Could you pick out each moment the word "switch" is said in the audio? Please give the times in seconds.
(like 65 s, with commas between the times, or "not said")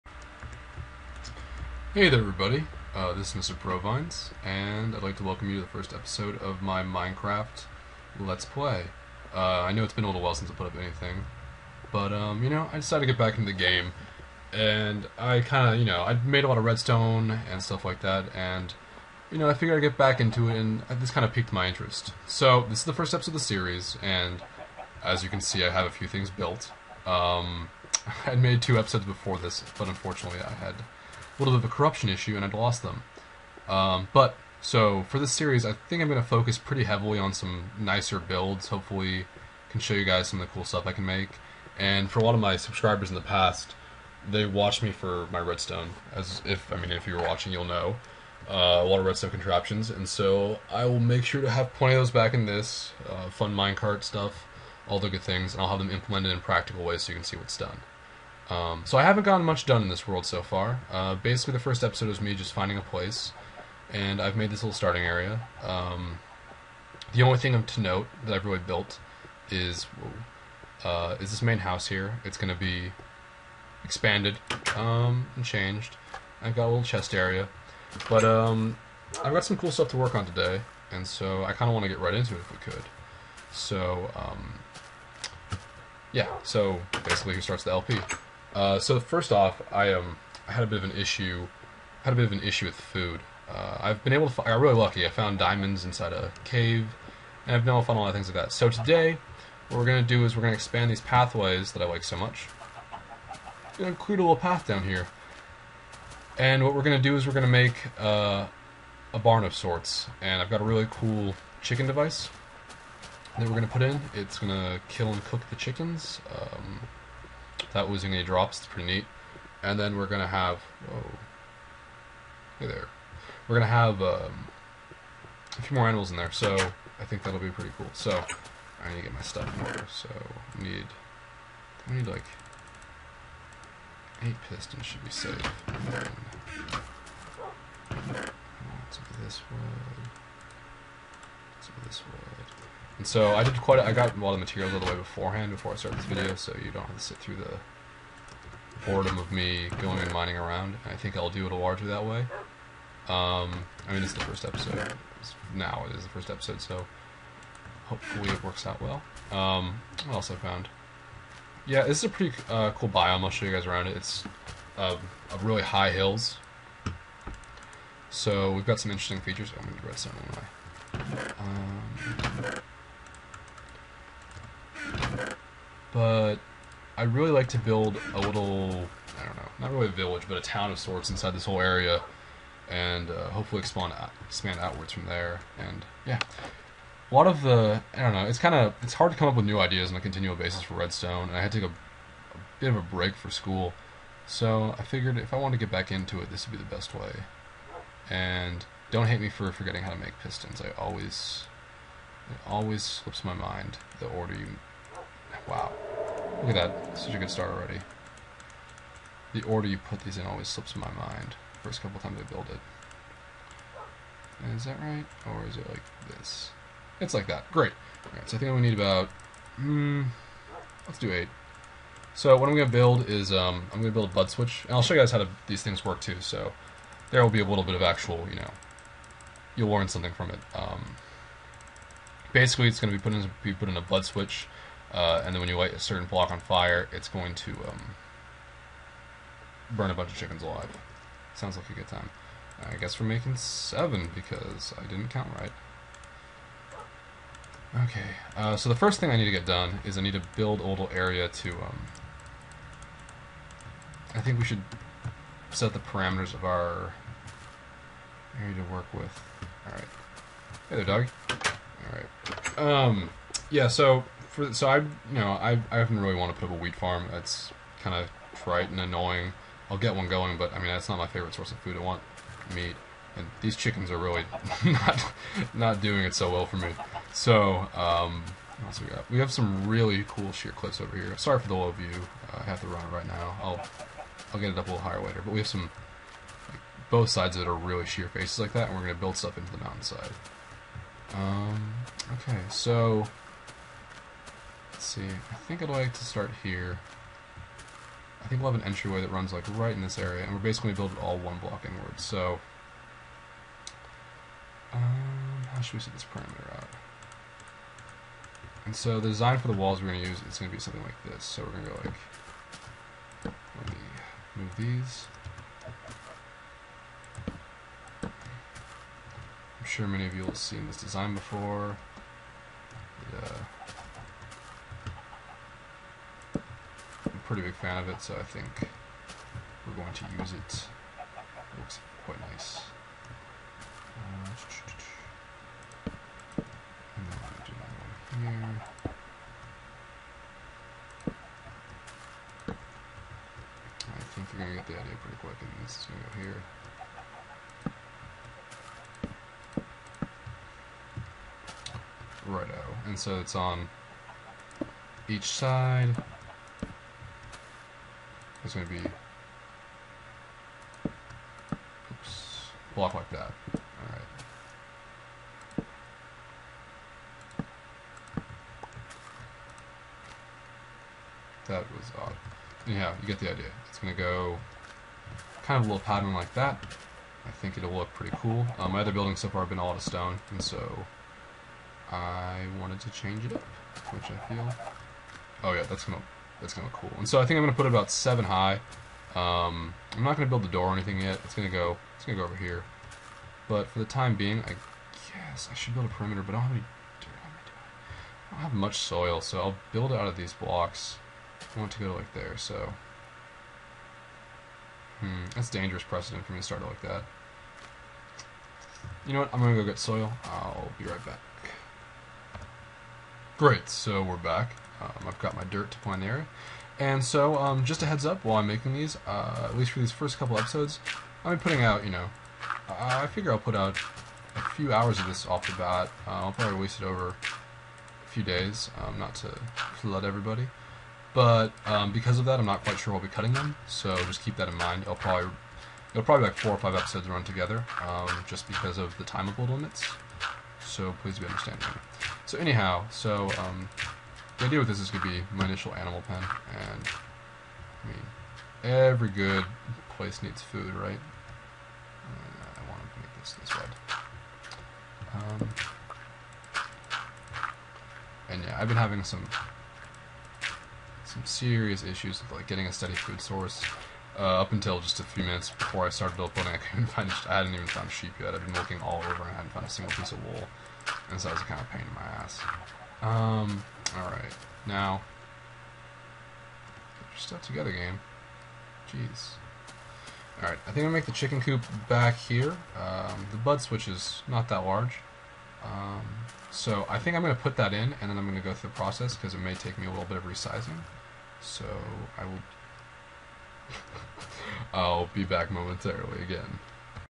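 224 s, 234 s, 483 s.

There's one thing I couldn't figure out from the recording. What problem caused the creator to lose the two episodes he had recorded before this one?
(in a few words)
Corruption.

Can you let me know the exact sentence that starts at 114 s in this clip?
It's gonna kill and cook the chickens.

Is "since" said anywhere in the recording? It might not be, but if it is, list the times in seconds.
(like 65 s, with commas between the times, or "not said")
10 s.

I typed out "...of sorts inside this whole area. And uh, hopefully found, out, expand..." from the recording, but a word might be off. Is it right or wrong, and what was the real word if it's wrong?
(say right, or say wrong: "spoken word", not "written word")
wrong: "expand", not "found".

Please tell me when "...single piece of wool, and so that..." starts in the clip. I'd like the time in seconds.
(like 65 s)
469 s.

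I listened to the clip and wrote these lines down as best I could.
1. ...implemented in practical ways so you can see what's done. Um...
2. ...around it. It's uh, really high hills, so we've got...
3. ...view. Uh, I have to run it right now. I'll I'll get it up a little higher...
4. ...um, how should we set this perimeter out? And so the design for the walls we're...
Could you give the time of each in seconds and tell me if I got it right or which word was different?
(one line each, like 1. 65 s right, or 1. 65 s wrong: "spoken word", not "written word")
1. 55 s right
2. 163 s right
3. 281 s right
4. 304 s right.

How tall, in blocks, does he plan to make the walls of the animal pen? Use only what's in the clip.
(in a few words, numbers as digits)
7.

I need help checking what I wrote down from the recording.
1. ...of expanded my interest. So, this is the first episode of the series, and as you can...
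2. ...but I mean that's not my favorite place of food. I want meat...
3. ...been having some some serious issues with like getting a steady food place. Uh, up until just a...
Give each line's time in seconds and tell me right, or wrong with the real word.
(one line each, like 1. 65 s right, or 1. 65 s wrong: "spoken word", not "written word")
1. 21 s wrong: "piqued", not "expanded"
2. 270 s wrong: "source", not "place"
3. 458 s wrong: "source", not "place".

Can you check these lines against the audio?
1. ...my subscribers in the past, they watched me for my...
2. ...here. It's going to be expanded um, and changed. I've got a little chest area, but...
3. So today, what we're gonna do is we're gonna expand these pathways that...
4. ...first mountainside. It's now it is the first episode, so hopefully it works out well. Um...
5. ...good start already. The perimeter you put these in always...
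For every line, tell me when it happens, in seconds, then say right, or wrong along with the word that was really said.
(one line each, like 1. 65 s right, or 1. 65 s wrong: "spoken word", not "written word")
1. 42 s right
2. 71 s right
3. 98 s right
4. 154 s wrong: "episode", not "mountainside"
5. 207 s wrong: "order", not "perimeter".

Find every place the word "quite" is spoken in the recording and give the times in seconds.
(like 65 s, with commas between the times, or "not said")
143 s, 332 s, 432 s.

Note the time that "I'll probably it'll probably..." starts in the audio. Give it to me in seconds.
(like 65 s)
434 s.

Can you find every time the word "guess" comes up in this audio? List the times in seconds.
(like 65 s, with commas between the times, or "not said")
242 s, 395 s.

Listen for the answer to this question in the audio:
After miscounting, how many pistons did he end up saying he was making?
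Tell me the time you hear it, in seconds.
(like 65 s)
243 s.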